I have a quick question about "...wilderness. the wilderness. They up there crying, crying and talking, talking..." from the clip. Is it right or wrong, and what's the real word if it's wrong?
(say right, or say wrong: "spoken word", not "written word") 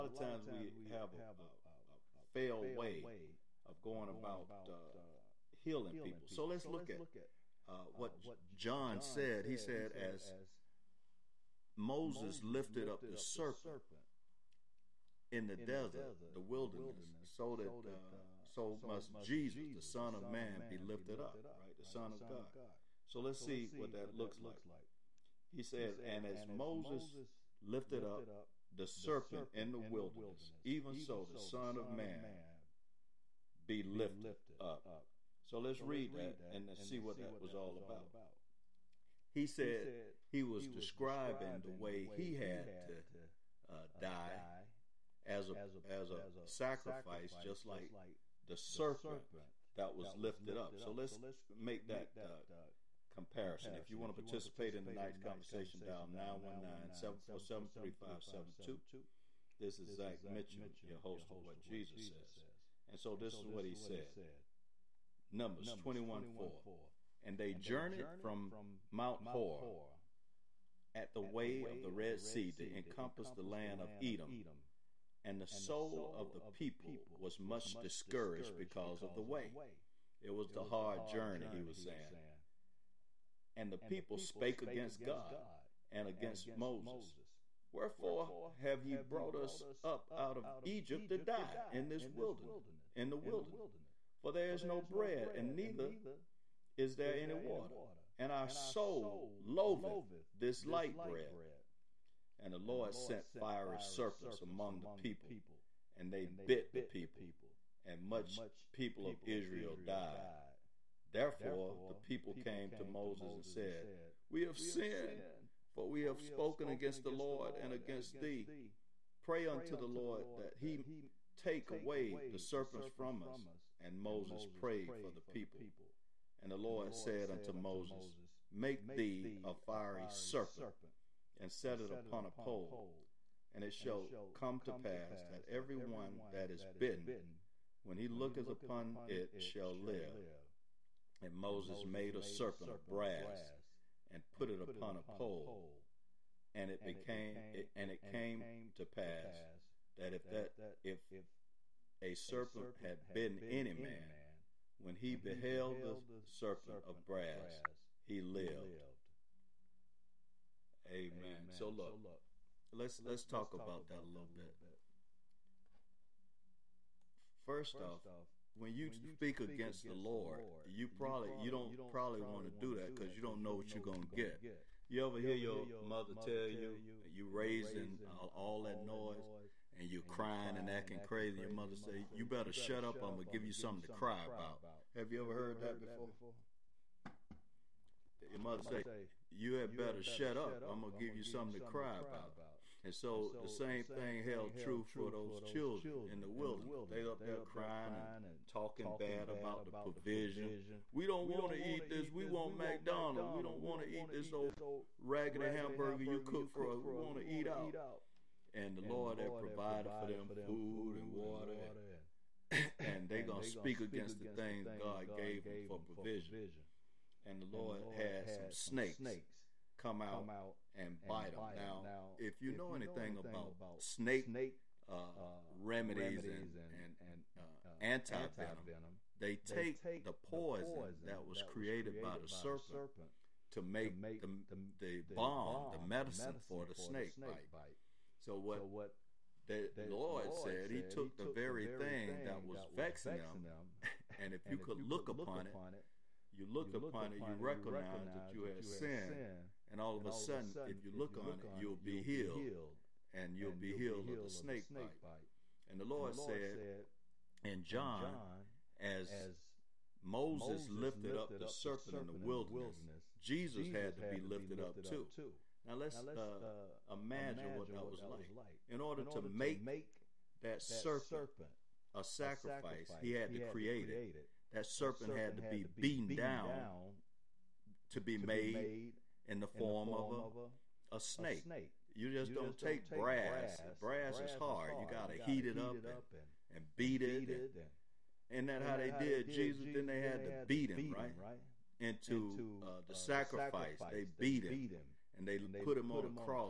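right.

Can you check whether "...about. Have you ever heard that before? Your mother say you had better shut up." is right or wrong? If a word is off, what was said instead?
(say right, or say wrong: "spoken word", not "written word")
right.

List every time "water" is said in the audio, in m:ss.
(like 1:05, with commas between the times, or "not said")
1:37, 3:31.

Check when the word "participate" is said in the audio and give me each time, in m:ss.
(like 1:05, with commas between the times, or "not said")
0:54.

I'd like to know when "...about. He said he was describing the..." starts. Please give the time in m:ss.
0:37.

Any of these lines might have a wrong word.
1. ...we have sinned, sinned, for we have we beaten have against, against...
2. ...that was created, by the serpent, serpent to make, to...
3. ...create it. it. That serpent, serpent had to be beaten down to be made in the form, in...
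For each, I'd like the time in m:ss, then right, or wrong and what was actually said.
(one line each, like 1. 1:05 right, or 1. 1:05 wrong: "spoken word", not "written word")
1. 1:54 wrong: "spoken", not "beaten"
2. 3:51 right
3. 4:33 right.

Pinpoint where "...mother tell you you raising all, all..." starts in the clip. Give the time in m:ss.
2:56.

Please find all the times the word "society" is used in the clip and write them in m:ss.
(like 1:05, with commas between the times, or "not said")
not said.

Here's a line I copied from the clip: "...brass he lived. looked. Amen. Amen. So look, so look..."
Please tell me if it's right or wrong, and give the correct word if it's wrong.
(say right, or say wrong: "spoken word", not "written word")
wrong: "lived", not "looked".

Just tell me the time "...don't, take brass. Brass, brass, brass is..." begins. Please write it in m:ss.
4:42.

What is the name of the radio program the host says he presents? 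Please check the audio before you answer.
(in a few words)
What Jesus Says.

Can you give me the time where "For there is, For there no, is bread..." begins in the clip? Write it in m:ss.
1:34.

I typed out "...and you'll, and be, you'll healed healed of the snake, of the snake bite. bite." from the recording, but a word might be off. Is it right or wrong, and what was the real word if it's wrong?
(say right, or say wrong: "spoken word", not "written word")
right.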